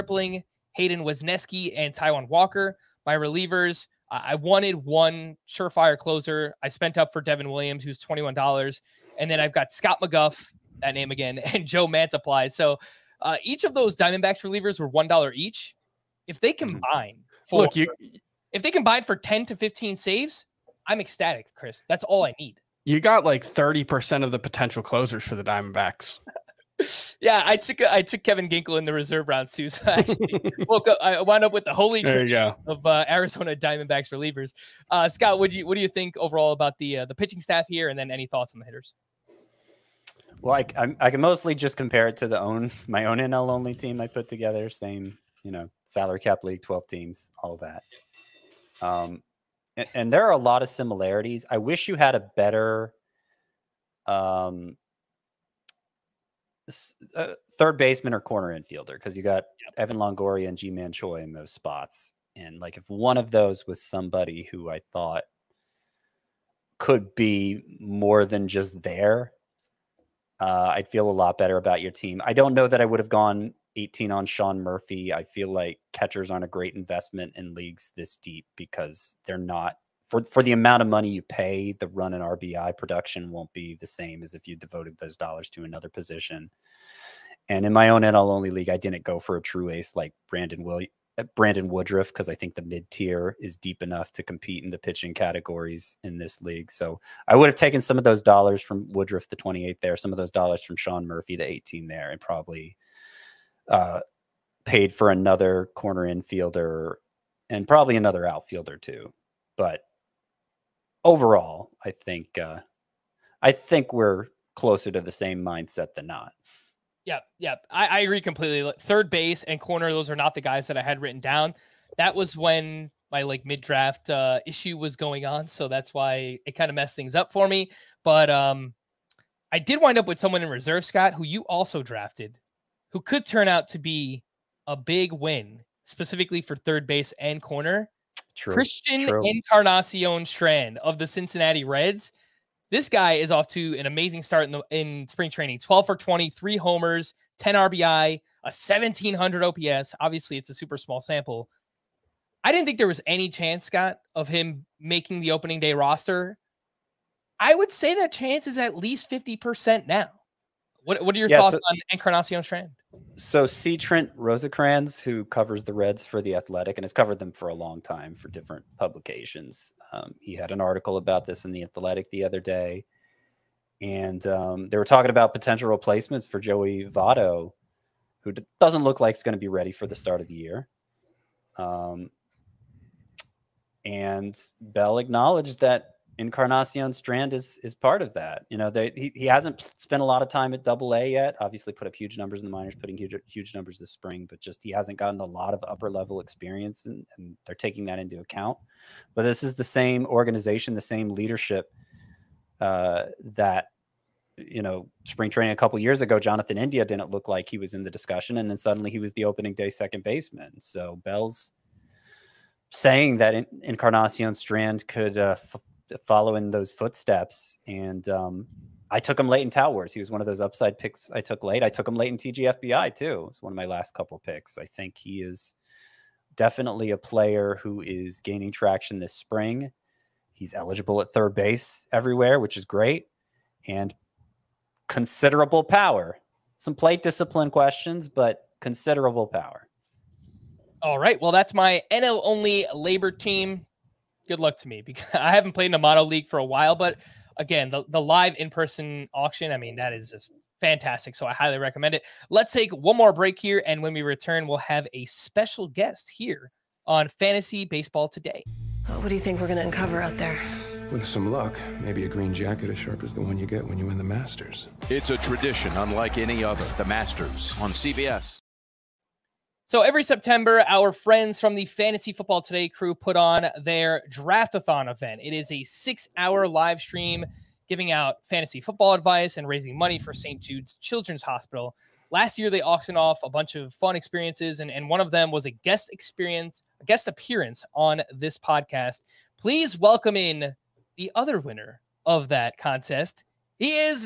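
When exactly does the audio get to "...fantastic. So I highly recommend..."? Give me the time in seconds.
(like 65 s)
250 s.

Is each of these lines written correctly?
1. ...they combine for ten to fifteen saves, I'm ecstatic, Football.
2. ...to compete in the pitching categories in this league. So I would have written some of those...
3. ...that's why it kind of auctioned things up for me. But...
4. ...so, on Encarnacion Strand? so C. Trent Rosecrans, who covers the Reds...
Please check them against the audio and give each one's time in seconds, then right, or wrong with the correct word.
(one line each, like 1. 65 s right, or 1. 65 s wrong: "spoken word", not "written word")
1. 18 s wrong: "Chris", not "Football"
2. 94 s wrong: "taken", not "written"
3. 125 s wrong: "messed", not "auctioned"
4. 161 s right.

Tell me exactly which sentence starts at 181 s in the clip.
Um, and Bell acknowledged that Encarnacion Strand is is part of that.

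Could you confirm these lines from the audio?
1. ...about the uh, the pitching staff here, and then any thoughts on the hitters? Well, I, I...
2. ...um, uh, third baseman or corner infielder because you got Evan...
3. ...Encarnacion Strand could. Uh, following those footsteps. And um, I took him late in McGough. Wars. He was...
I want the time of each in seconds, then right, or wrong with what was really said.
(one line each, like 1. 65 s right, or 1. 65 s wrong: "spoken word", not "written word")
1. 36 s right
2. 54 s right
3. 213 s wrong: "Towers", not "McGough".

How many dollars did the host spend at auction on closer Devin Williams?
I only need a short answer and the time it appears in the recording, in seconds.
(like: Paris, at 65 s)
$21, at 8 s.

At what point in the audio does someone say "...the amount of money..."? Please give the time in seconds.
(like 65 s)
80 s.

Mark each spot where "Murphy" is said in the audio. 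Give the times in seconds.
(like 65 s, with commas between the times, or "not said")
74 s, 101 s.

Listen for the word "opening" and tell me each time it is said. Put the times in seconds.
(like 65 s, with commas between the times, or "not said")
155 s, 209 s.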